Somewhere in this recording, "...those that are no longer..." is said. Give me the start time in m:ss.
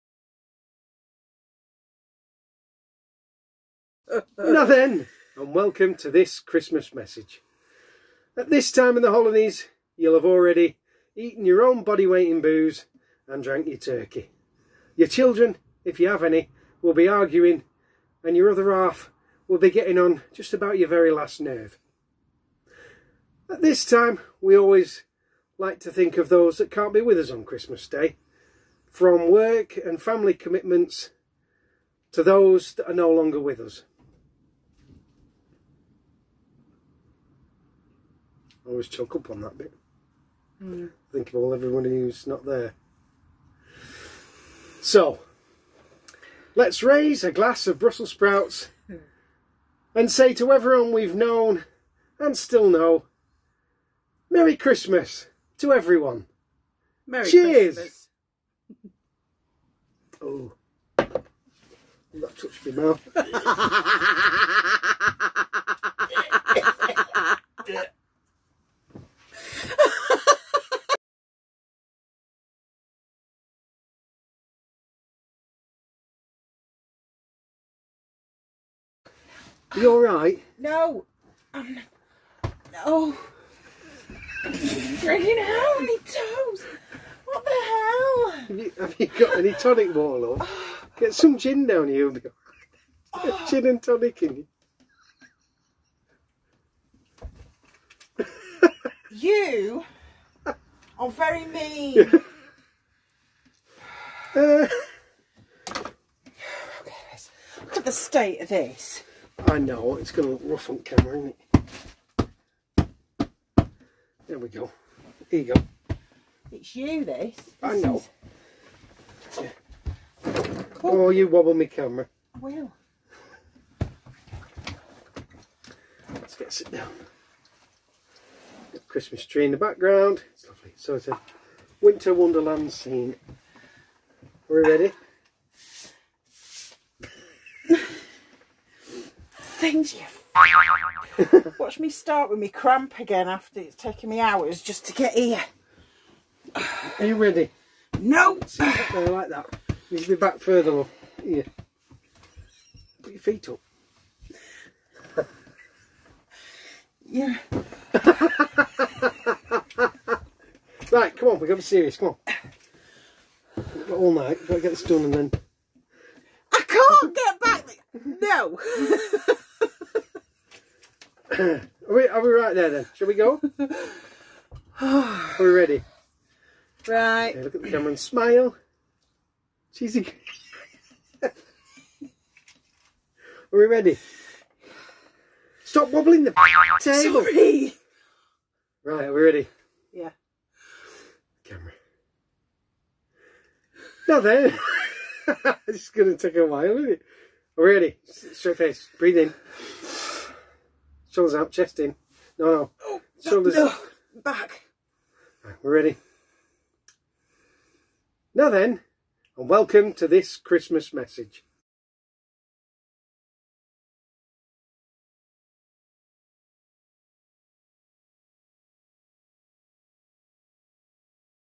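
0:32.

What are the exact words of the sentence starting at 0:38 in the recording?
I always choke up on that bit.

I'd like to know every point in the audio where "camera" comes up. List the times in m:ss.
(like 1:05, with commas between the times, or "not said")
1:50, 2:01, 2:57, 3:11.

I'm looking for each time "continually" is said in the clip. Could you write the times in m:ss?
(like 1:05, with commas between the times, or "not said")
not said.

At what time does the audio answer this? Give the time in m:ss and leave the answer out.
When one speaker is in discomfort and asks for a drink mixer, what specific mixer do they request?
1:29.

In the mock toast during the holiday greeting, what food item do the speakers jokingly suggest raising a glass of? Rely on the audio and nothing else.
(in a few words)
Brussels sprouts.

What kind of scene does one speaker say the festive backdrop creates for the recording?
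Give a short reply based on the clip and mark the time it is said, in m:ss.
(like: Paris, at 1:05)
winter wonderland, at 2:11.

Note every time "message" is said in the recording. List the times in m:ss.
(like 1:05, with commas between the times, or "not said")
0:06, 3:30.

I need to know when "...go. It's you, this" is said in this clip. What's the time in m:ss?
1:55.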